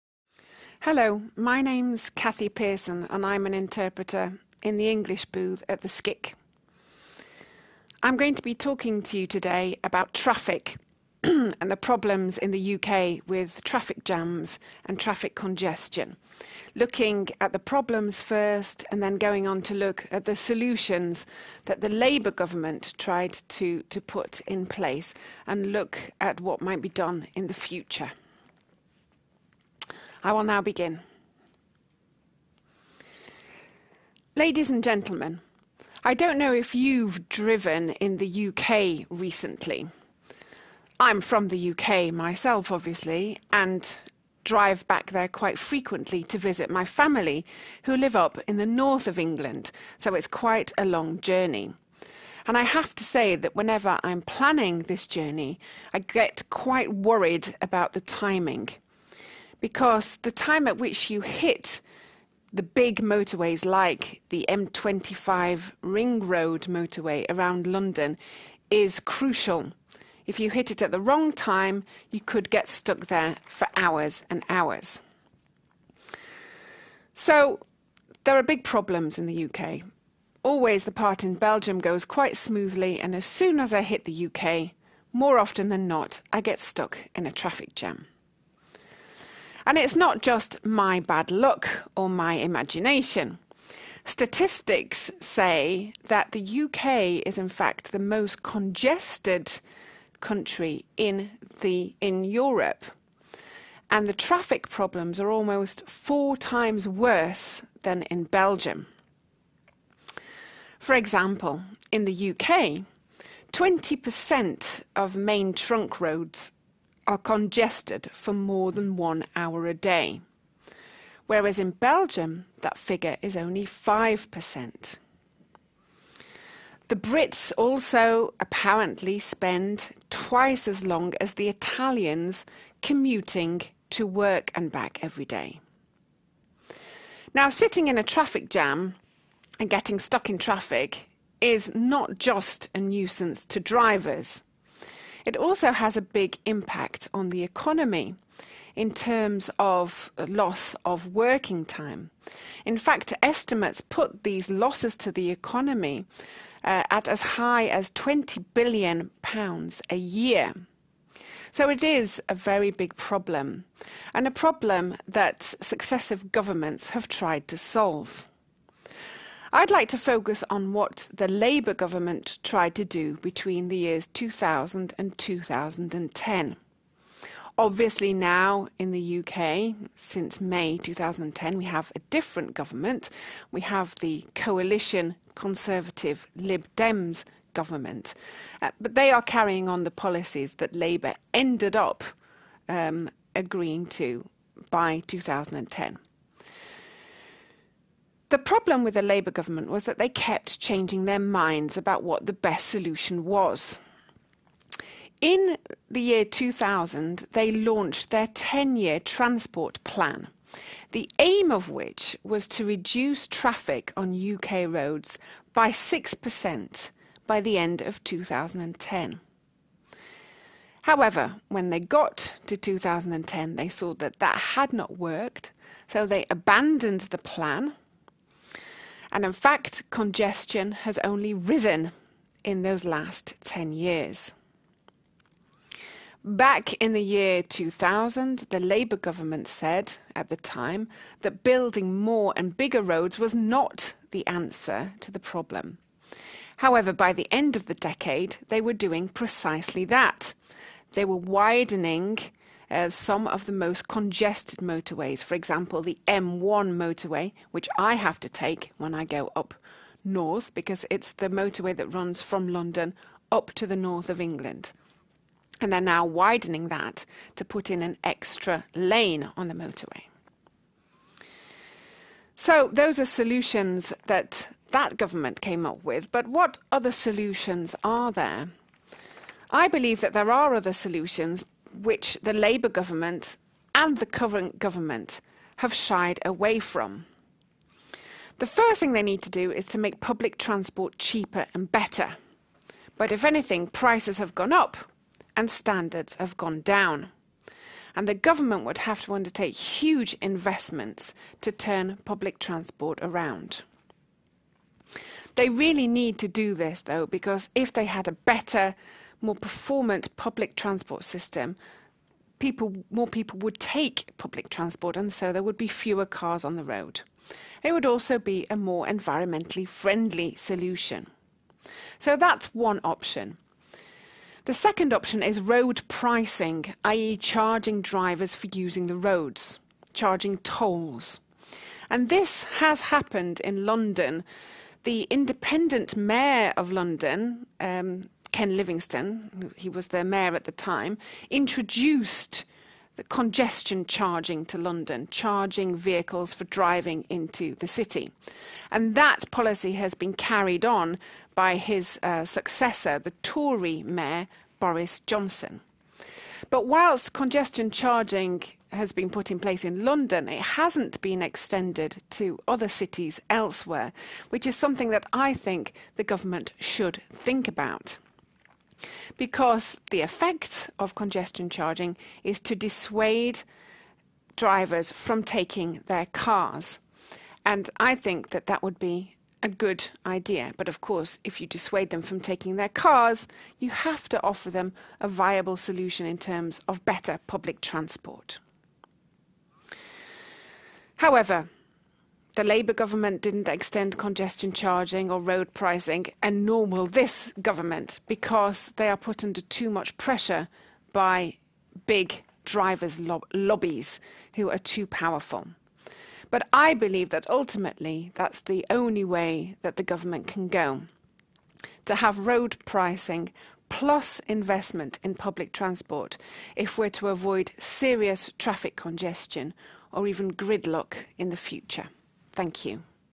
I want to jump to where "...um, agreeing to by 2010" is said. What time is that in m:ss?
3:12.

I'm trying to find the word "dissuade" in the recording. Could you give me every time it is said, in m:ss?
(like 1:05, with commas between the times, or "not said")
6:12, 6:21.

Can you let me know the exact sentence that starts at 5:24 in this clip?
The second option is road pricing, i.e.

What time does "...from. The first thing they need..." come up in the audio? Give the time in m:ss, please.
4:46.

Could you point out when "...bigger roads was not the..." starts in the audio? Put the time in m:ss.
4:02.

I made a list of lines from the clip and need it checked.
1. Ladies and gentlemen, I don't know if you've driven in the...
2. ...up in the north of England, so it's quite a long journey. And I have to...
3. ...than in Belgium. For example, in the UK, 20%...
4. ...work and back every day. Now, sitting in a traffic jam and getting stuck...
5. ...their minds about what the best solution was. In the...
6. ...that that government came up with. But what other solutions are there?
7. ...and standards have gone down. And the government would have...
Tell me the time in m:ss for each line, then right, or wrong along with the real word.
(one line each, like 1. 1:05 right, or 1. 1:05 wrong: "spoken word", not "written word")
1. 0:34 right
2. 0:48 right
3. 1:47 right
4. 2:14 right
5. 3:21 right
6. 4:34 right
7. 4:55 right.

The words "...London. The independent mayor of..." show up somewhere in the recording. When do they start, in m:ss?
5:33.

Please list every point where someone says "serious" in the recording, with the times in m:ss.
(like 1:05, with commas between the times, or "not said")
6:57.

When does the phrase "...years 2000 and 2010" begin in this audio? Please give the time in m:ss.
2:53.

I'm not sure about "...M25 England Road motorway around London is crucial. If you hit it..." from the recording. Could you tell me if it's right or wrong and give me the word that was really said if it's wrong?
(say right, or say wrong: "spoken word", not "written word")
wrong: "Ring", not "England".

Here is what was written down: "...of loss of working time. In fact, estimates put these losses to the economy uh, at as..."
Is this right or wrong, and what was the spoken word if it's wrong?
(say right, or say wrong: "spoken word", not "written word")
right.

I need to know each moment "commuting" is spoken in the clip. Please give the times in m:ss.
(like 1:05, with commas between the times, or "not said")
2:12.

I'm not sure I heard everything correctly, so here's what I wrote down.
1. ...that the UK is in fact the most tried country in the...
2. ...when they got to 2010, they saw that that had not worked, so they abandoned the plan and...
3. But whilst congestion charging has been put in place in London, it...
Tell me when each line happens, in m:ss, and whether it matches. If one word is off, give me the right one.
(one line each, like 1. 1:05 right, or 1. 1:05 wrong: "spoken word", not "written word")
1. 1:36 wrong: "congested", not "tried"
2. 3:41 right
3. 5:56 right.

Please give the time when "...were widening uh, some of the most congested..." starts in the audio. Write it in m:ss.
4:11.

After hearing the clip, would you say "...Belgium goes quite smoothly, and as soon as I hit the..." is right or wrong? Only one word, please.
right.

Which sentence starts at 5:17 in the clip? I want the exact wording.
It would also be a more environmentally friendly solution.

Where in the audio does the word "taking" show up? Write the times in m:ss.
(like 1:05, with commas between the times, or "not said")
6:15, 6:22.